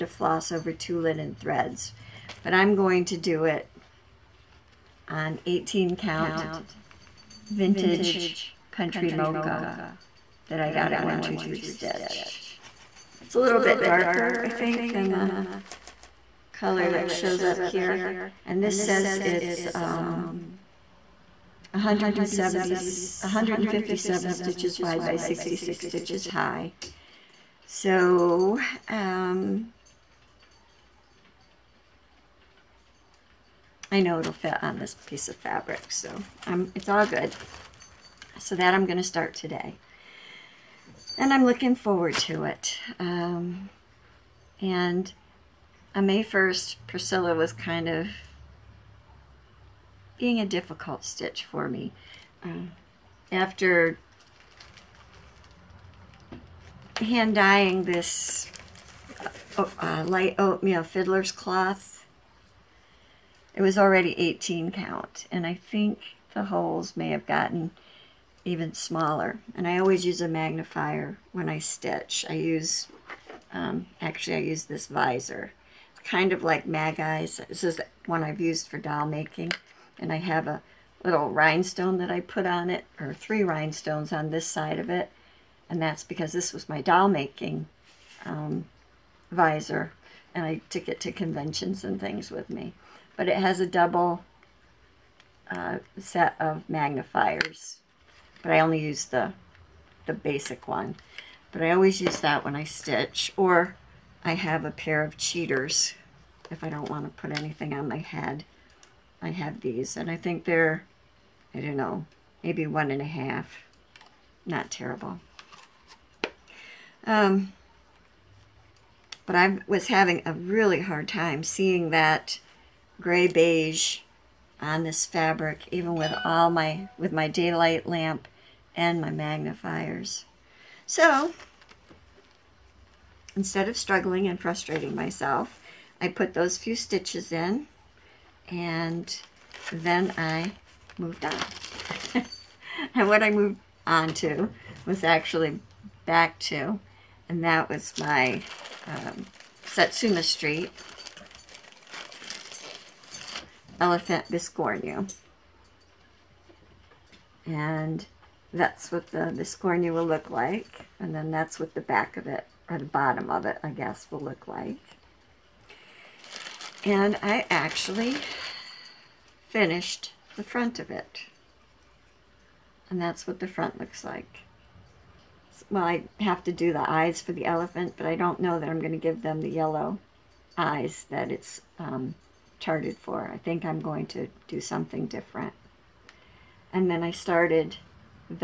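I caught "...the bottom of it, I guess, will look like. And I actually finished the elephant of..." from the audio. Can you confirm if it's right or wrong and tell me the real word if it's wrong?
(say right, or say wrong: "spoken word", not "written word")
wrong: "front", not "elephant".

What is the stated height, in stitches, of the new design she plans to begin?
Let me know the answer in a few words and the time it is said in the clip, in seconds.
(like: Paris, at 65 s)
66, at 25 s.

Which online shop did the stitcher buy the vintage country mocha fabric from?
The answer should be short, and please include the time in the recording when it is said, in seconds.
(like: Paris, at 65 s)
123 Stitch, at 11 s.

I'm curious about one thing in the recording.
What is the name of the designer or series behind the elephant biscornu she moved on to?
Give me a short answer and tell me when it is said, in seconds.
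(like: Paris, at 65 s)
Satsuma Street, at 149 s.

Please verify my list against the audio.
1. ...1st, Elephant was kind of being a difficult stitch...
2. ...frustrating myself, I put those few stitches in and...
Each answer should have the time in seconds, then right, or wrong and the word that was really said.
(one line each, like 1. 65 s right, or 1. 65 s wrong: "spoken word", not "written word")
1. 46 s wrong: "Priscilla", not "Elephant"
2. 134 s right.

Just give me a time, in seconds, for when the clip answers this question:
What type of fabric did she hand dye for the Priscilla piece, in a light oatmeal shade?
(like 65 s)
60 s.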